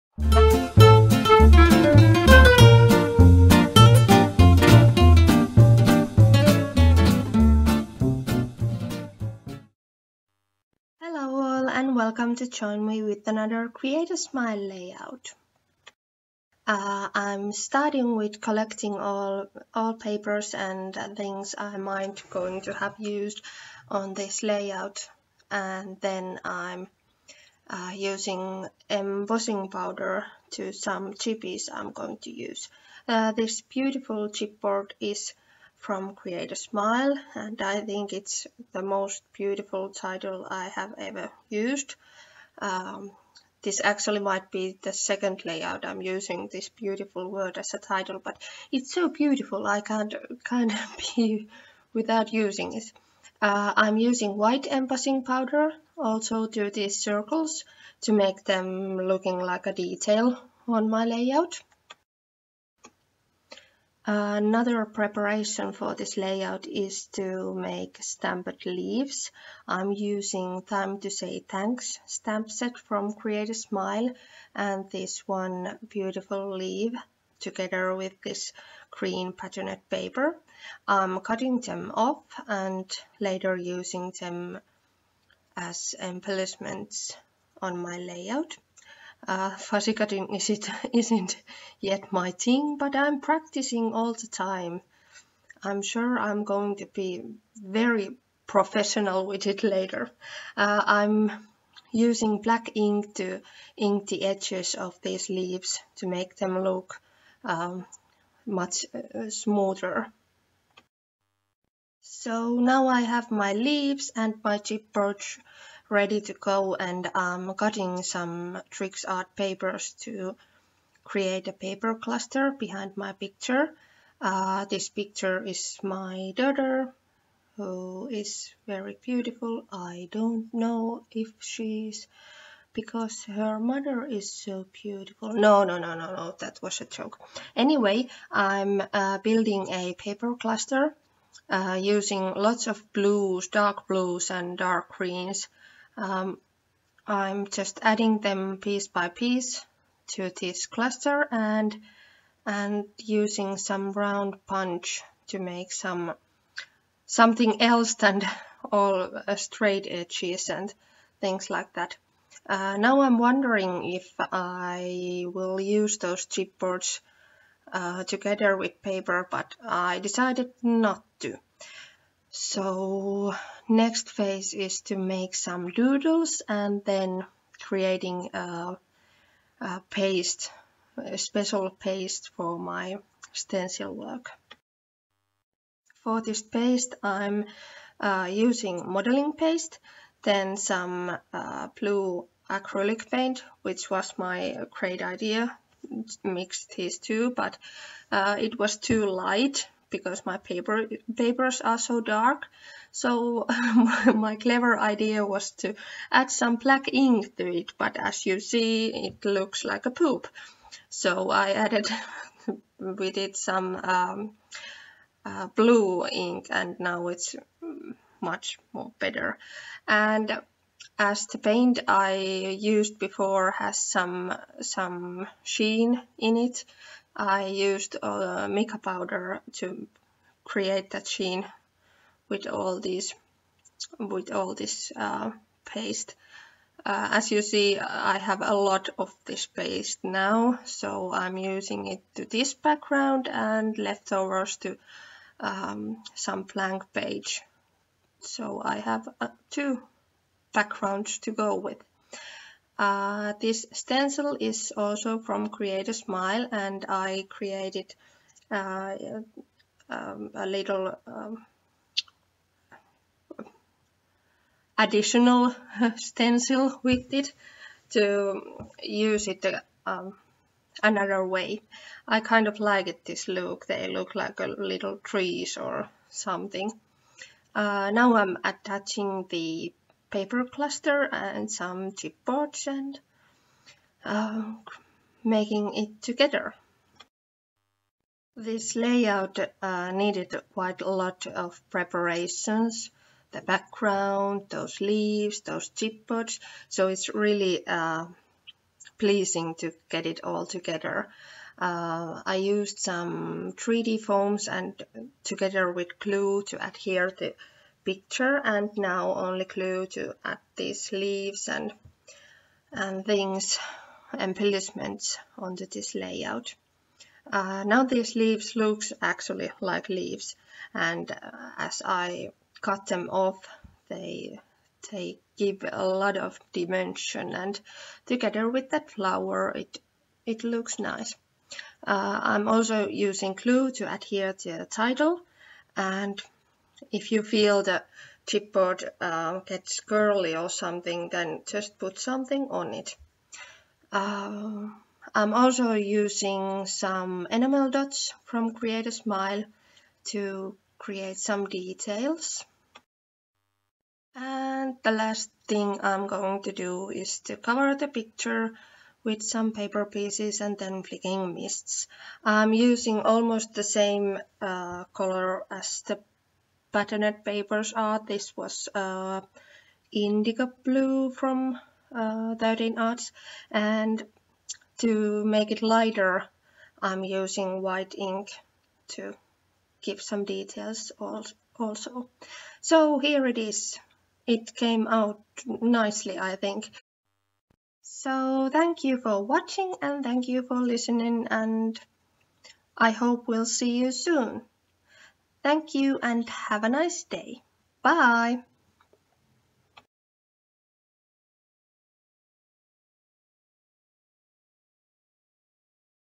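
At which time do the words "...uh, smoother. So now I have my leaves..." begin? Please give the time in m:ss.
1:48.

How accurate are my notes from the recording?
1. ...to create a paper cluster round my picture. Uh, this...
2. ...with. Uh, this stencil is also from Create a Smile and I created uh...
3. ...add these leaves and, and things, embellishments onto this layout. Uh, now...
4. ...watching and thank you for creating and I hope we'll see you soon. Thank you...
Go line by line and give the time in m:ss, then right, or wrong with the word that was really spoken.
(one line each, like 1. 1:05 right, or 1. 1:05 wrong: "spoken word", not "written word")
1. 2:00 wrong: "behind", not "round"
2. 4:11 right
3. 5:10 right
4. 6:29 wrong: "listening", not "creating".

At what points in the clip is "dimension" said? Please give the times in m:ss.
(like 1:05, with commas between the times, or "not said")
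5:26.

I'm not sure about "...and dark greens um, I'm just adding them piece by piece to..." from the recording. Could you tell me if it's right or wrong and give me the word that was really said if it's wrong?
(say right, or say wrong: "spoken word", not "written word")
right.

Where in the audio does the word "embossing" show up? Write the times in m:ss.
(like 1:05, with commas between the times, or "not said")
0:28, 0:54.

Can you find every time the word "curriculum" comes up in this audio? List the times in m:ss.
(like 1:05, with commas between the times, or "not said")
not said.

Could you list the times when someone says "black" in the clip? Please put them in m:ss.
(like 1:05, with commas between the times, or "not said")
1:42, 3:26.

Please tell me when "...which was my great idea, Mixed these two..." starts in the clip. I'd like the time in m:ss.
3:13.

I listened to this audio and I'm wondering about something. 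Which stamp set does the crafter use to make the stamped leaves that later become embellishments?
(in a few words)
Time to Say Thanks.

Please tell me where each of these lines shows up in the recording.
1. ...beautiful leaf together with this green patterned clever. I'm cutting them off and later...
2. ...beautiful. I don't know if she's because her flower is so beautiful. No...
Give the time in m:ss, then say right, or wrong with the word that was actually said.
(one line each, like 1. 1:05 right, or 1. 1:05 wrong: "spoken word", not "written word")
1. 1:15 wrong: "paper", not "clever"
2. 2:09 wrong: "mother", not "flower".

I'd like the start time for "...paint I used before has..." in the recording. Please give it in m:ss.
3:41.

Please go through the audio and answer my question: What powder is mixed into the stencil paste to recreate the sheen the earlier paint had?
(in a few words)
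Mica powder.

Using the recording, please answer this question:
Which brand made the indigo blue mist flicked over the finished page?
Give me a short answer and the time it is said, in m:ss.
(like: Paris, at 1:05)
13 Arts, at 6:12.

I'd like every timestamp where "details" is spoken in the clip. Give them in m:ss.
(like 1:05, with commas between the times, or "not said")
0:59, 5:51, 6:20.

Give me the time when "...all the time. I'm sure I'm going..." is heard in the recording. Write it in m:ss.
1:33.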